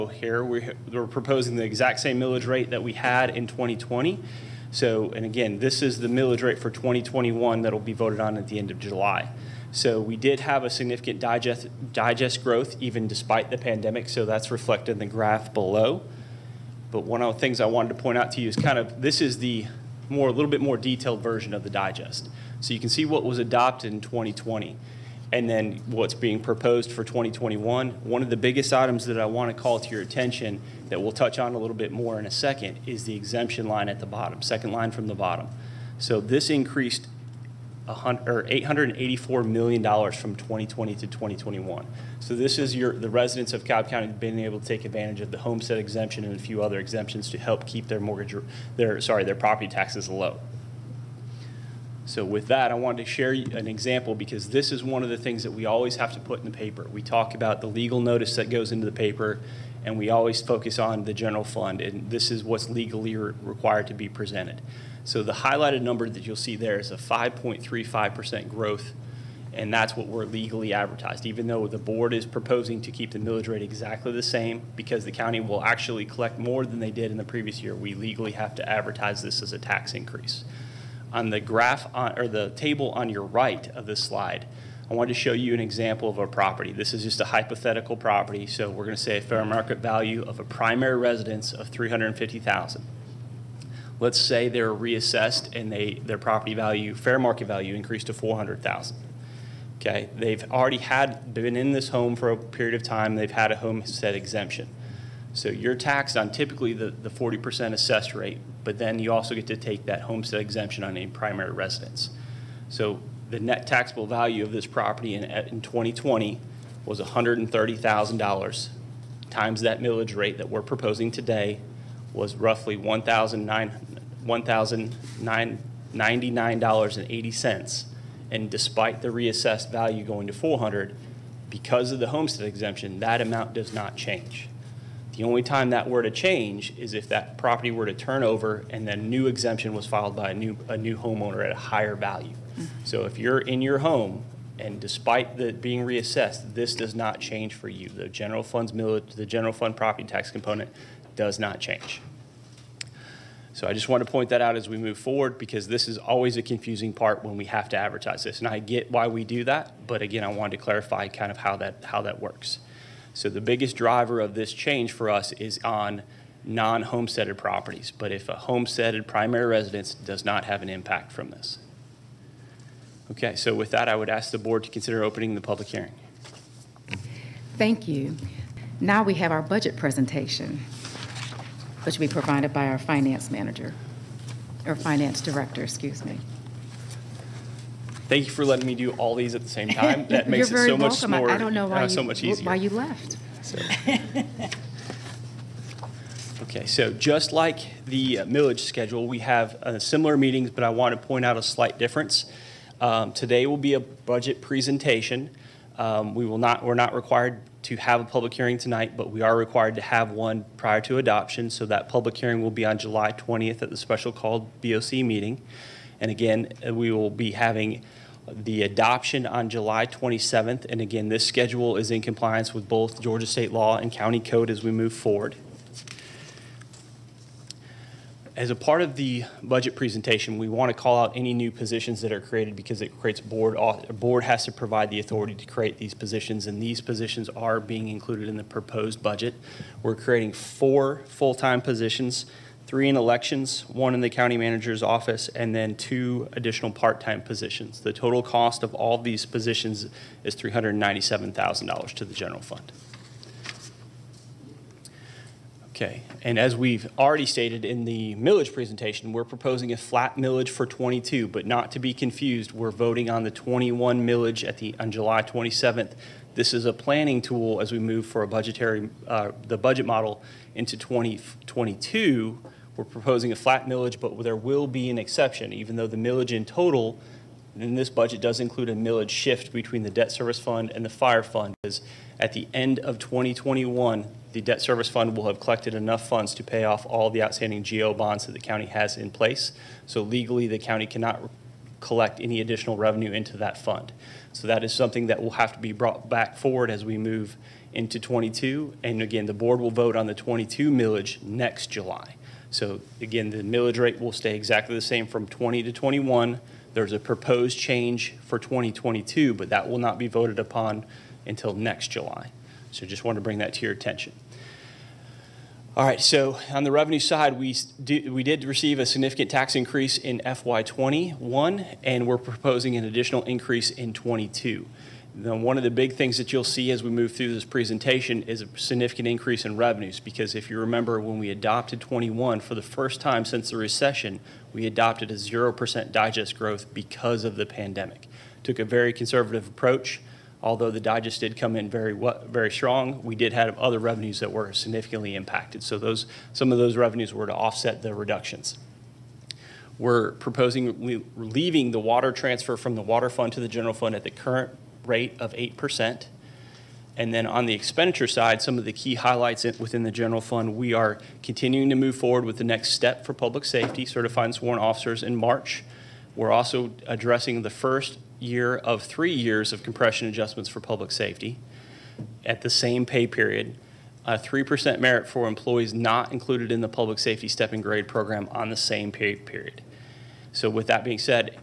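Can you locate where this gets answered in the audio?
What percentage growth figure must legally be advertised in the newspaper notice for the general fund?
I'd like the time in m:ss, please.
1:06.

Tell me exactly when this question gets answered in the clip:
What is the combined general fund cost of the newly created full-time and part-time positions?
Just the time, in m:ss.
4:10.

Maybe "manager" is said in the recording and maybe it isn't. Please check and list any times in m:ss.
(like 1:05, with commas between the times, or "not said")
3:03, 4:04.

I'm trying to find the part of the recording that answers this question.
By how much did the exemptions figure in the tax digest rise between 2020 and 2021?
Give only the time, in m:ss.
0:38.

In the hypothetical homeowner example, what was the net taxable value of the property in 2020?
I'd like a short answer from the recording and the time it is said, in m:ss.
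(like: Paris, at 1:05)
$130,000, at 1:56.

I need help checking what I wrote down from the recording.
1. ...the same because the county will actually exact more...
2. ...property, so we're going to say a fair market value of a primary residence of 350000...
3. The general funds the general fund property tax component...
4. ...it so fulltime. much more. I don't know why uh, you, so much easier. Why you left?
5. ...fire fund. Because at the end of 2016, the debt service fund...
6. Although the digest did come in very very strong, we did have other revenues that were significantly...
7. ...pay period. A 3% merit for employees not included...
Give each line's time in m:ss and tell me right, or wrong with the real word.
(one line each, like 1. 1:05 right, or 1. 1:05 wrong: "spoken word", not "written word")
1. 1:14 wrong: "collect", not "exact"
2. 1:27 right
3. 2:27 right
4. 3:10 wrong: "welcome", not "fulltime"
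5. 4:40 wrong: "2021", not "2016"
6. 5:40 right
7. 6:12 right.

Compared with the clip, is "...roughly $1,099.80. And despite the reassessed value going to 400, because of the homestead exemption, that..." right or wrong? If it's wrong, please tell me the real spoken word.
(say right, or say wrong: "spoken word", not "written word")
right.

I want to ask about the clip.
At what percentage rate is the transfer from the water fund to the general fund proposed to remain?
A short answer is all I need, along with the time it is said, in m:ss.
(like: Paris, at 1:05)
8%, at 5:55.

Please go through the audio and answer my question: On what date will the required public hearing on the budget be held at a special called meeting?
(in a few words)
July 20th.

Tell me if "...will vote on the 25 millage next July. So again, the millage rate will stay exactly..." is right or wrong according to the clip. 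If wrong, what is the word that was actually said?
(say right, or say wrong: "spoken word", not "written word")
wrong: "22", not "25".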